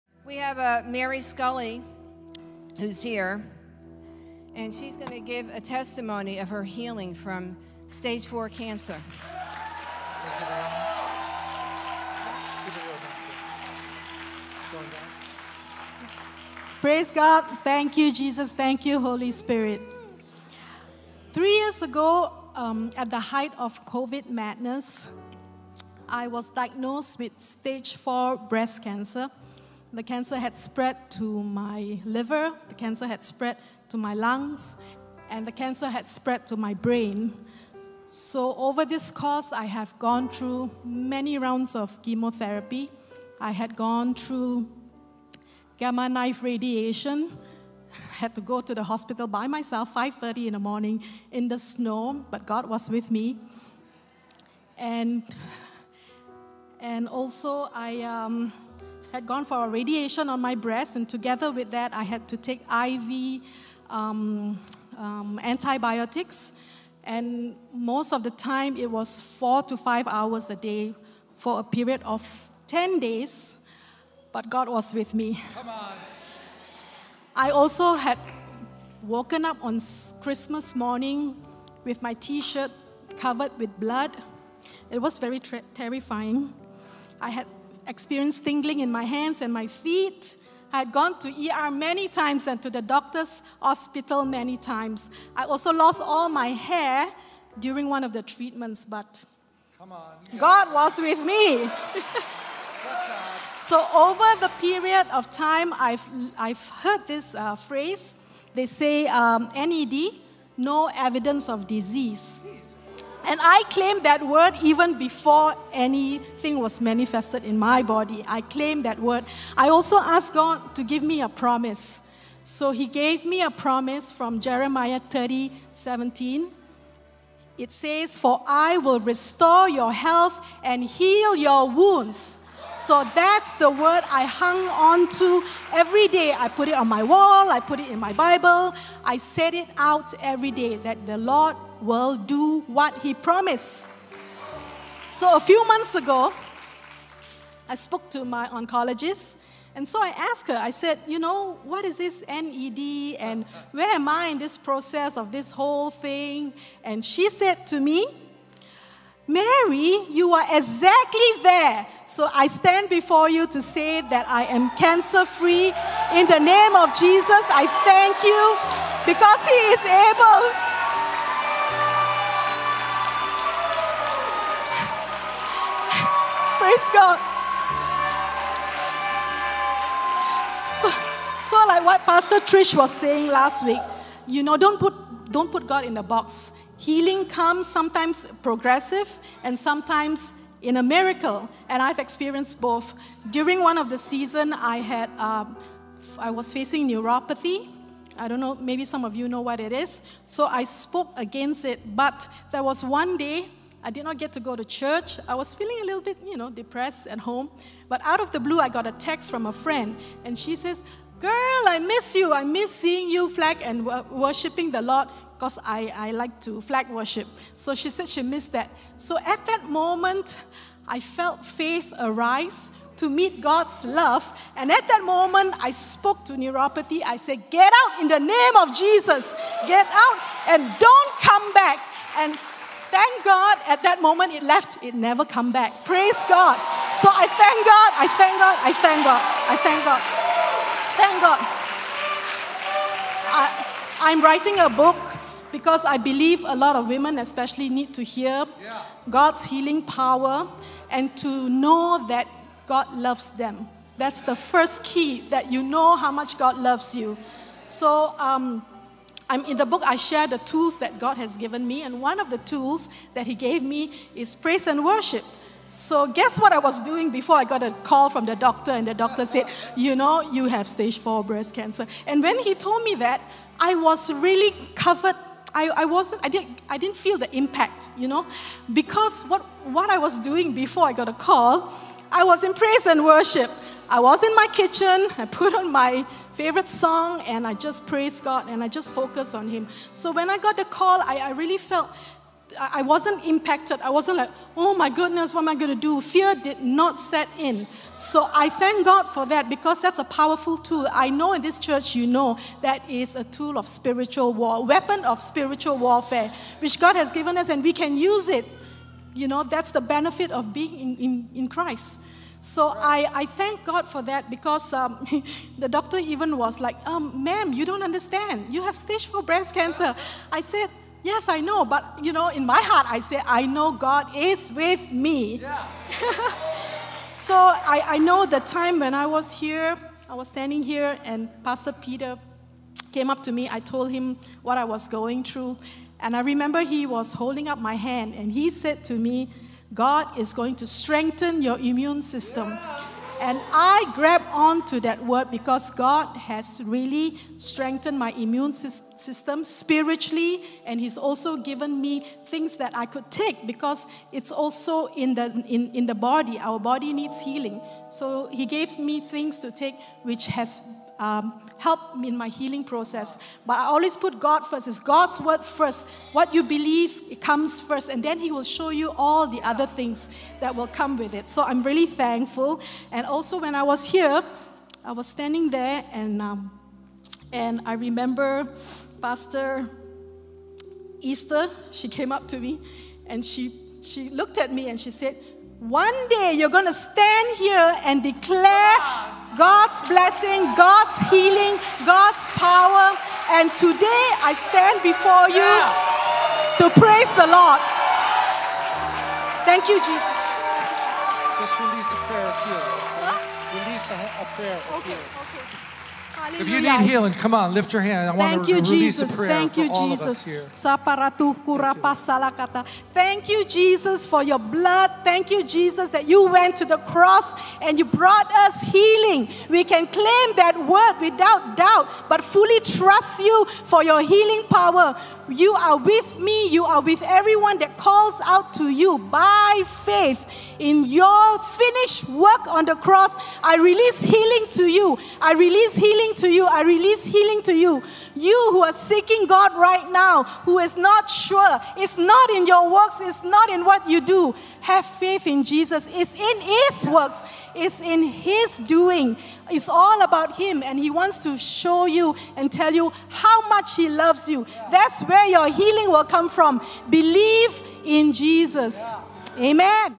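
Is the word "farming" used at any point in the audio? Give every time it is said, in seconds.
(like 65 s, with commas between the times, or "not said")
not said.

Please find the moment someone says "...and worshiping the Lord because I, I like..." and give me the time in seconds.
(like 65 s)
213 s.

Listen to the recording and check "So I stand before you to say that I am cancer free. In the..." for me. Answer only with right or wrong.
right.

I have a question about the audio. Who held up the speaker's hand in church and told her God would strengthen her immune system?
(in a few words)
Pastor Peter.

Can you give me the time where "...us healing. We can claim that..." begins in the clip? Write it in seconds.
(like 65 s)
418 s.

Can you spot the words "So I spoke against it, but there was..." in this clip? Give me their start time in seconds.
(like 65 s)
200 s.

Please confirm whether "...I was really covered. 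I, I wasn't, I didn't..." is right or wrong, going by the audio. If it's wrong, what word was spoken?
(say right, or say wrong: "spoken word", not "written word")
right.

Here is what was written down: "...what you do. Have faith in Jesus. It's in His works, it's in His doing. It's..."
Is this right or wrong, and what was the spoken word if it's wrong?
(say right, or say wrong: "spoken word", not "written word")
right.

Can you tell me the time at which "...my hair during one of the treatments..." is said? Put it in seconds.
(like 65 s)
96 s.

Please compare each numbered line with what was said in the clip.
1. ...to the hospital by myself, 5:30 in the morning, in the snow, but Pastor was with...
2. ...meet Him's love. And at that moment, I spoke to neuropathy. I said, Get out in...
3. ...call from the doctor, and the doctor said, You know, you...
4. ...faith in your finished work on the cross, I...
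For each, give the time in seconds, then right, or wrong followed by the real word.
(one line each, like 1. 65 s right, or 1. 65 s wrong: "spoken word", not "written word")
1. 48 s wrong: "God", not "Pastor"
2. 223 s wrong: "God", not "Him"
3. 267 s right
4. 429 s right.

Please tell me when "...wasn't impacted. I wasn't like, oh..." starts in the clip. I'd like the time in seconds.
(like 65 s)
292 s.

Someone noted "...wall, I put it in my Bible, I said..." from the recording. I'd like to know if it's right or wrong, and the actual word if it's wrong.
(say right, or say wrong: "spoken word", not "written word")
right.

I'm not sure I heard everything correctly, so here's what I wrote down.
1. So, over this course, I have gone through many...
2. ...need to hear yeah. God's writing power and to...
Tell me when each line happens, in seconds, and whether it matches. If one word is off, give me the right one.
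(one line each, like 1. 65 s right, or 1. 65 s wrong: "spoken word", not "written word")
1. 38 s right
2. 247 s wrong: "healing", not "writing".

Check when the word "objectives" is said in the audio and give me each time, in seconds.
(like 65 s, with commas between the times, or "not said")
not said.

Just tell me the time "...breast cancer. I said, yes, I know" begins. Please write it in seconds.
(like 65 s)
319 s.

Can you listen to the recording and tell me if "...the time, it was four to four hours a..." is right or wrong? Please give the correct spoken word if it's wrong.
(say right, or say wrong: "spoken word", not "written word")
wrong: "five", not "four".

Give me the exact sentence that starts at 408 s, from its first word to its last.
I want Thank to you, release Jesus.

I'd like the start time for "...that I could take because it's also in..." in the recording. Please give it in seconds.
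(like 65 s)
352 s.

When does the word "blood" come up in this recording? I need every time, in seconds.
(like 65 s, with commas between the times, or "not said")
83 s, 414 s.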